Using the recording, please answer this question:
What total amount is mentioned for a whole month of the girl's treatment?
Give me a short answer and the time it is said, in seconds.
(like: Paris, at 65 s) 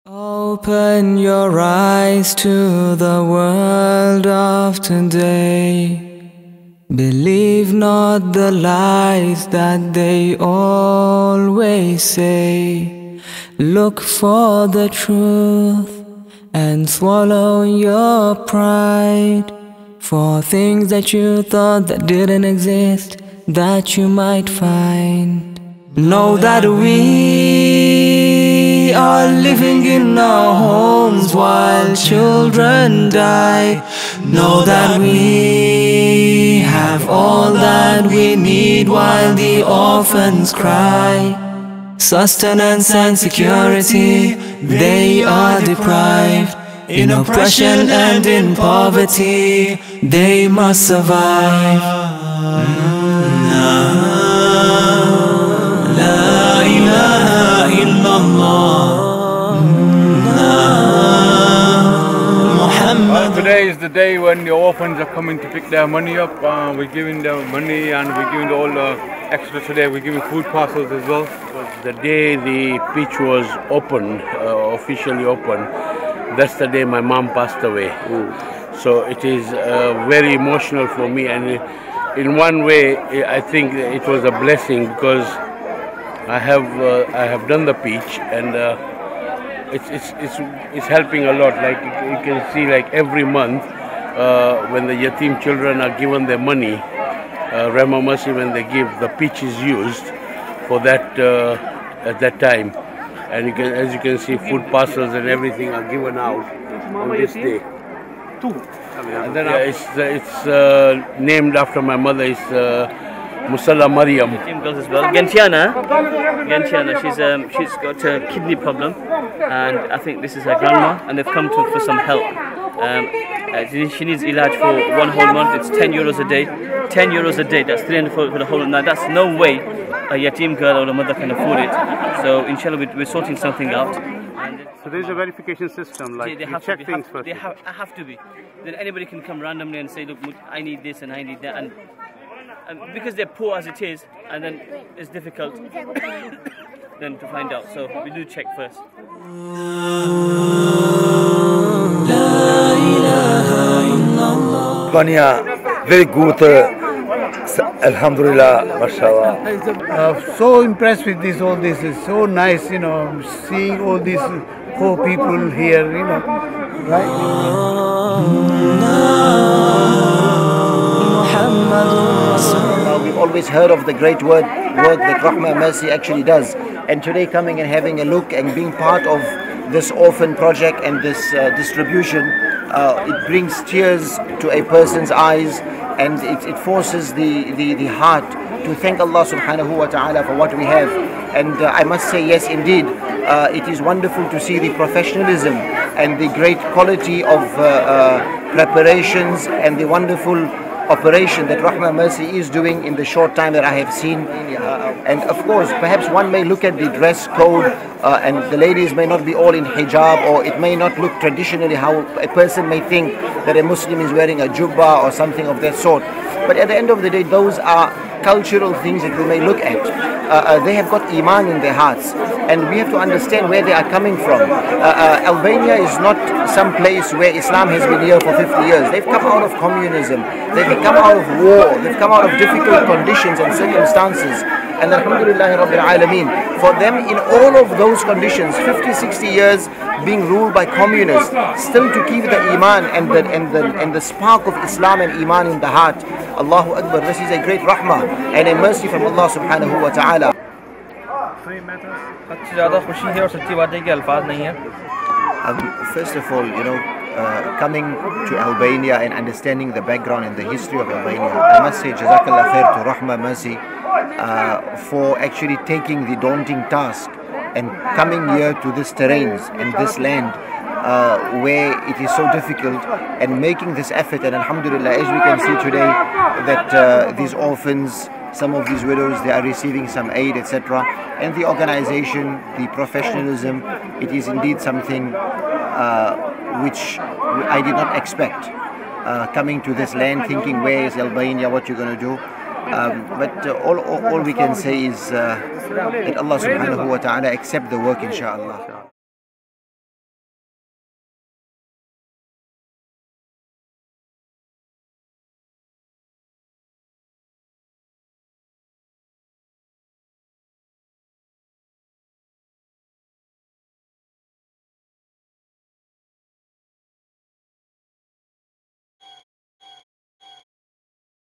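300, at 127 s.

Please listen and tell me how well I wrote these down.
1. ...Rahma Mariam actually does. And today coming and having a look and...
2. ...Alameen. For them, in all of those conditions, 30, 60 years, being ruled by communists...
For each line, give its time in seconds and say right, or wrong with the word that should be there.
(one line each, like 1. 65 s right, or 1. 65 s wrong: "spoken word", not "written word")
1. 175 s wrong: "Mercy", not "Mariam"
2. 235 s wrong: "50", not "30".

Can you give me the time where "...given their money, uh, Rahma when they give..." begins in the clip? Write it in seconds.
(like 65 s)
95 s.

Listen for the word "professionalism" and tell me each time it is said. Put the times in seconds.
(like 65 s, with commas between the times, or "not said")
194 s, 282 s.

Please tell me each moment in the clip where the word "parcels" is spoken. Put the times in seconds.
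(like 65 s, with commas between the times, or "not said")
70 s, 104 s.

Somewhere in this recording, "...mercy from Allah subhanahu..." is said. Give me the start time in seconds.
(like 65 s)
248 s.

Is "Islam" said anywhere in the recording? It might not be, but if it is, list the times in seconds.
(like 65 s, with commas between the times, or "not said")
227 s, 244 s.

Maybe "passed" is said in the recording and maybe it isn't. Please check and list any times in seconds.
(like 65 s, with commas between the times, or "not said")
77 s.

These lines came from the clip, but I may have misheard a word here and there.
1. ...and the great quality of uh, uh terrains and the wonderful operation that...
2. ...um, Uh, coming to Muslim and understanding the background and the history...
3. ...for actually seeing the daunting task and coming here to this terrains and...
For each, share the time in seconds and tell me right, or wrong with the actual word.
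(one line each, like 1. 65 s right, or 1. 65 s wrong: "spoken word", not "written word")
1. 195 s wrong: "preparations", not "terrains"
2. 256 s wrong: "Albania", not "Muslim"
3. 264 s wrong: "taking", not "seeing".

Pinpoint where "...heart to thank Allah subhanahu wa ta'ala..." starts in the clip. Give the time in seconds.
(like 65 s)
187 s.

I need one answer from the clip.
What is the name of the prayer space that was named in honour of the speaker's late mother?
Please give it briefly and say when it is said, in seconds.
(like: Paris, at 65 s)
Musalla Mariam, at 113 s.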